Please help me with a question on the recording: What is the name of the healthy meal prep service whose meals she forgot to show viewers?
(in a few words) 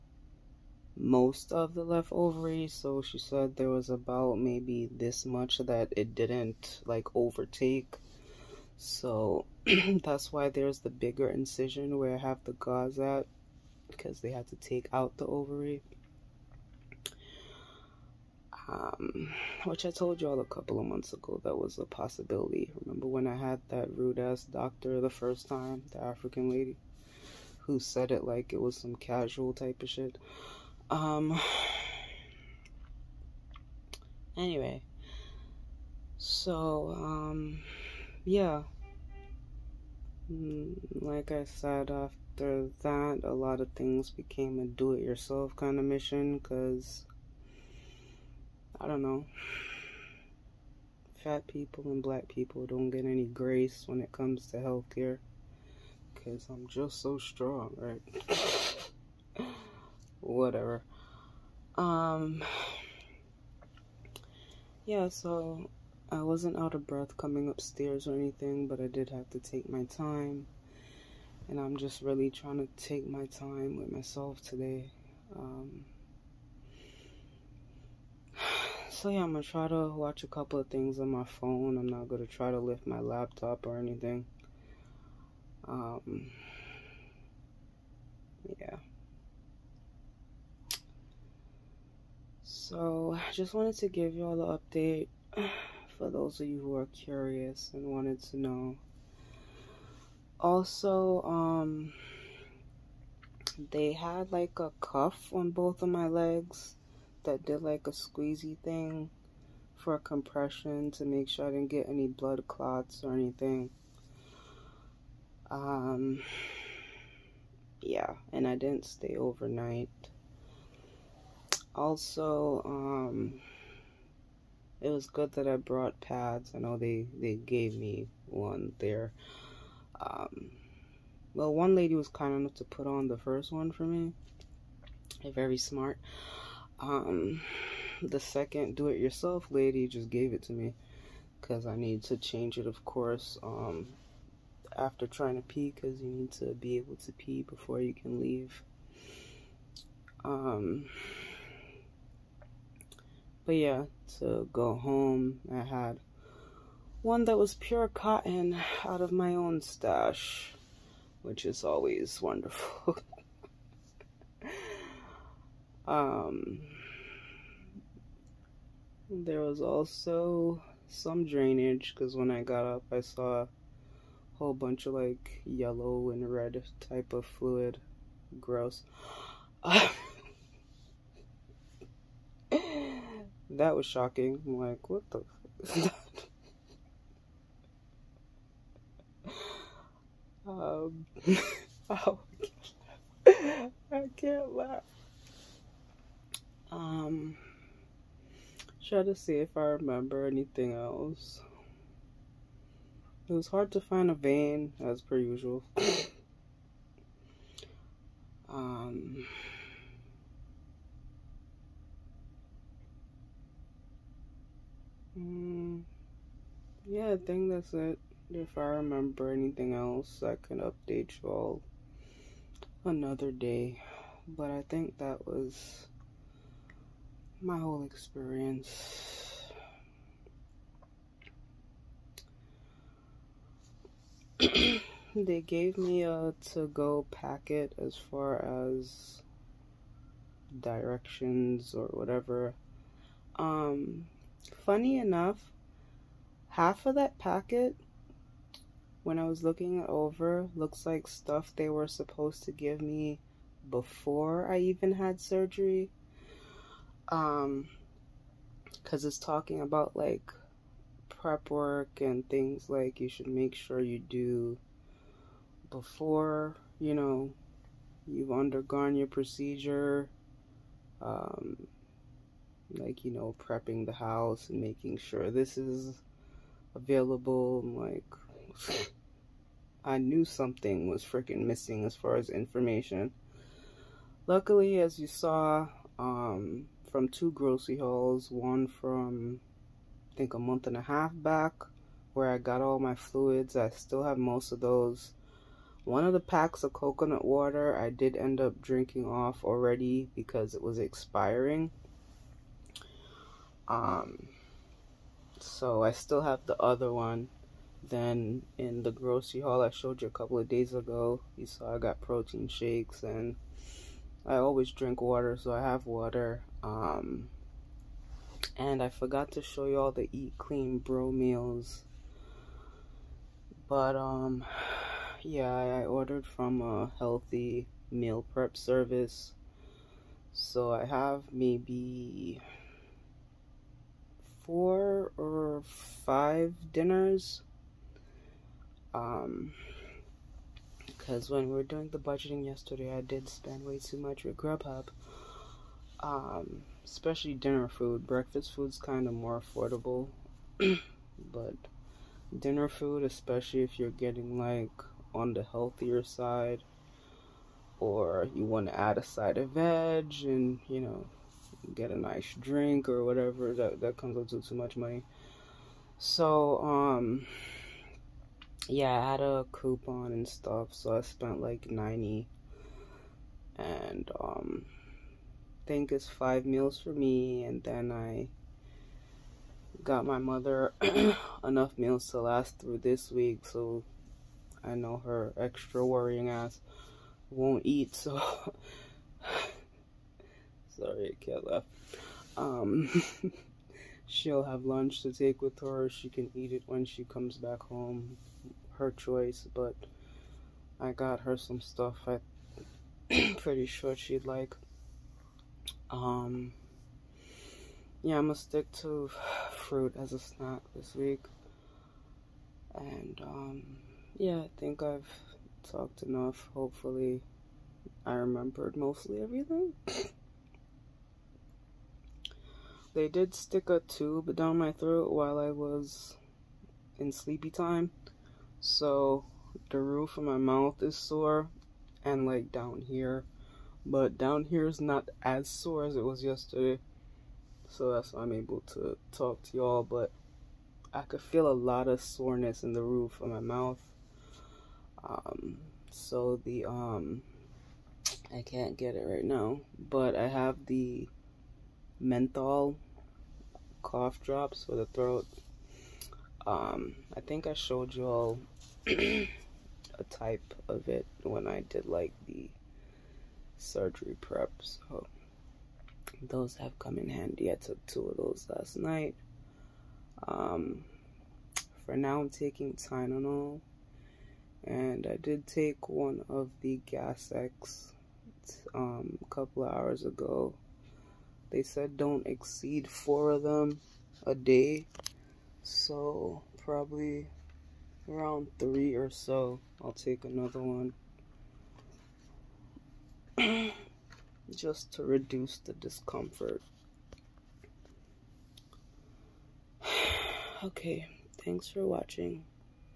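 Eat Clean Bro.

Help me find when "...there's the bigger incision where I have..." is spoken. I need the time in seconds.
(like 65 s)
10 s.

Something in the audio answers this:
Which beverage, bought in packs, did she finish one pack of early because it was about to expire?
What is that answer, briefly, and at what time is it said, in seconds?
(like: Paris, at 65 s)
Coconut water, at 296 s.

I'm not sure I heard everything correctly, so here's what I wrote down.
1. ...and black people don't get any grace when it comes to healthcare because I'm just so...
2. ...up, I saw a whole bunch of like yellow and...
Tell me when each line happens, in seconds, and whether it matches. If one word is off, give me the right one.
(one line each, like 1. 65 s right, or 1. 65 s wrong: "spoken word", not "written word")
1. 51 s right
2. 172 s right.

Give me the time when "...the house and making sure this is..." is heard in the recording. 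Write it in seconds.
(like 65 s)
273 s.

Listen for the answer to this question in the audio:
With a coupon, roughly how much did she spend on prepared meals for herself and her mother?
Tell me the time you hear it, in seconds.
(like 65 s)
371 s.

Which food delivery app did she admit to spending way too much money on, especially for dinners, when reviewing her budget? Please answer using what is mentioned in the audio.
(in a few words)
Grubhub.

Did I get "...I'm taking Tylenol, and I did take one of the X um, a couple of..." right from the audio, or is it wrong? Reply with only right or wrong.
right.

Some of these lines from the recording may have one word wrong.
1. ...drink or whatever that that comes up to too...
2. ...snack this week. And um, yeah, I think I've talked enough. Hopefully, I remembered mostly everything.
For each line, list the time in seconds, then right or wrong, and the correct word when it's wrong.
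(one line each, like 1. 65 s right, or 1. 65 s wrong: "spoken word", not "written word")
1. 362 s right
2. 410 s right.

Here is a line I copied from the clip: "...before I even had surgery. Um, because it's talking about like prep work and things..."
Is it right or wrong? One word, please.
right.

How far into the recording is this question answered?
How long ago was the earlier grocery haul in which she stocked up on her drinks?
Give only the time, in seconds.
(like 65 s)
290 s.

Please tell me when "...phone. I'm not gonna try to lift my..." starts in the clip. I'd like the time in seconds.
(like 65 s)
81 s.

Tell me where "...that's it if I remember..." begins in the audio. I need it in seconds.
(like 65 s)
217 s.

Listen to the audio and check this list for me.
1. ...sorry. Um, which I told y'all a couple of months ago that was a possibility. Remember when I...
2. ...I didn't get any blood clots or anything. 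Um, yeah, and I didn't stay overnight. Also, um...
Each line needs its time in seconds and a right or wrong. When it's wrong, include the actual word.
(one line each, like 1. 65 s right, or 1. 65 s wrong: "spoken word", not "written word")
1. 15 s wrong: "ovary", not "sorry"
2. 111 s right.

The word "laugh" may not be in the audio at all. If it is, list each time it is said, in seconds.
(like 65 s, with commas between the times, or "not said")
194 s, 391 s.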